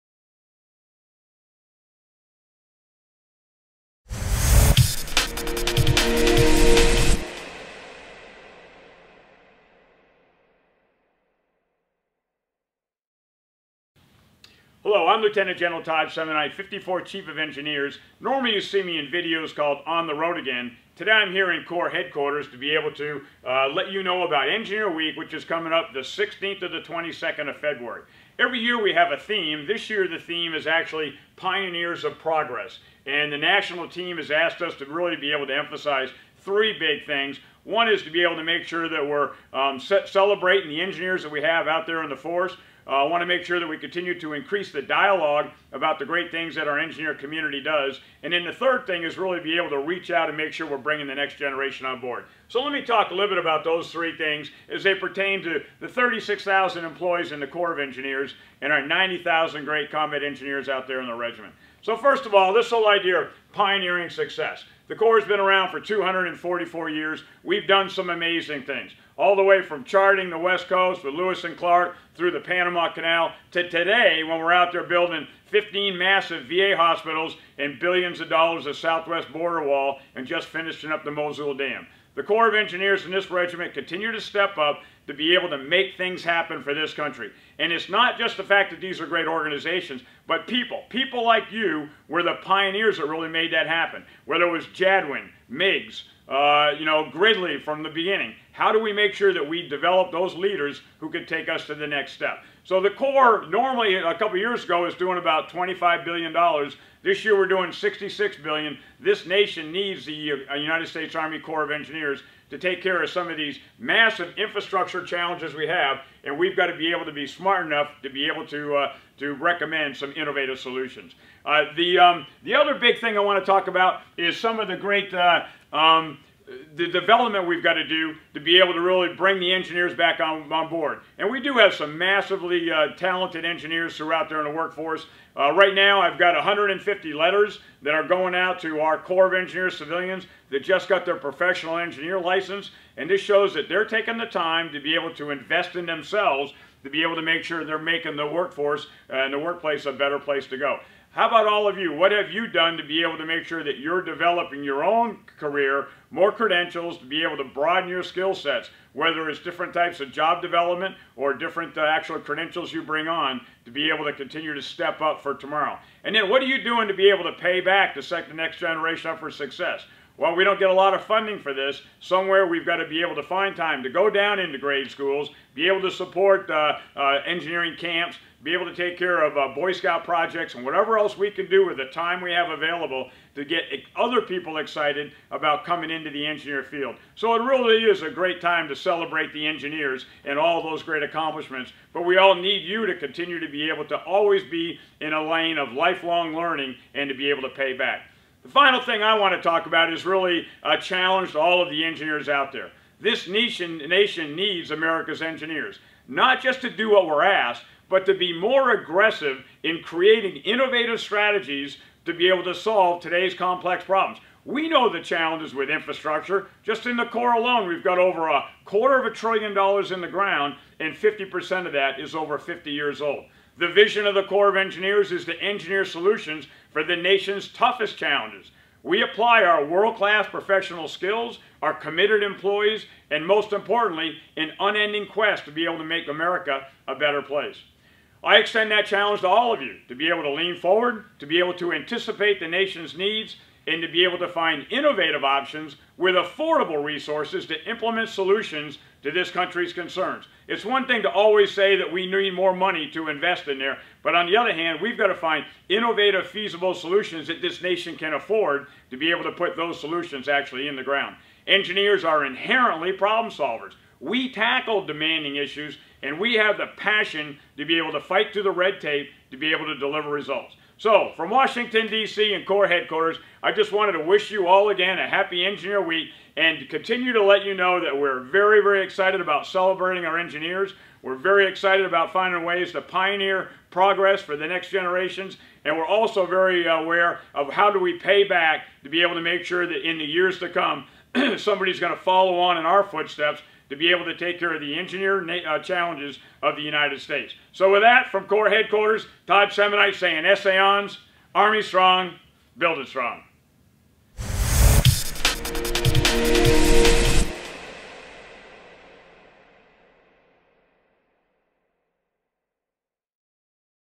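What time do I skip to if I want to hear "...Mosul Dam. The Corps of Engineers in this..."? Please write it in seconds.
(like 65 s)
81 s.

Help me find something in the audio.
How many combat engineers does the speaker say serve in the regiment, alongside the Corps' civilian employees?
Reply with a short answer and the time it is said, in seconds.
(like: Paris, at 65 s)
90,000, at 58 s.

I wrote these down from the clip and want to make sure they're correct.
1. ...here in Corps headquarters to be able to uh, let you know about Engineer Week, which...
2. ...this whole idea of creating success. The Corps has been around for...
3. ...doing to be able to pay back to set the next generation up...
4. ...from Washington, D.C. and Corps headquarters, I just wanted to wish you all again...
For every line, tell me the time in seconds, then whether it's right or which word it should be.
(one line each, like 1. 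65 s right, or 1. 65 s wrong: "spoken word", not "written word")
1. 21 s right
2. 62 s wrong: "pioneering", not "creating"
3. 166 s right
4. 271 s right.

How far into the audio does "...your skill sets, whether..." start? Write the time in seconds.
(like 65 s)
157 s.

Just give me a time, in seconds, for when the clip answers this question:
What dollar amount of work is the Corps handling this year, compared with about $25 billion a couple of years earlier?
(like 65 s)
107 s.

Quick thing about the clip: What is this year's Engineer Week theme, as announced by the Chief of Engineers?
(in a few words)
Pioneers of Progress.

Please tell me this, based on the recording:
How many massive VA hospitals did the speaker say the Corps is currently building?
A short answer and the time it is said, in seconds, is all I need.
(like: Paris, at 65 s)
15, at 75 s.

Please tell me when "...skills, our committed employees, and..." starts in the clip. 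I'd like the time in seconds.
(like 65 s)
230 s.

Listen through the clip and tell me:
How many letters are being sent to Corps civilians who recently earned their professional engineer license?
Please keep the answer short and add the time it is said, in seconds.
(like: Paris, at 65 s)
150, at 136 s.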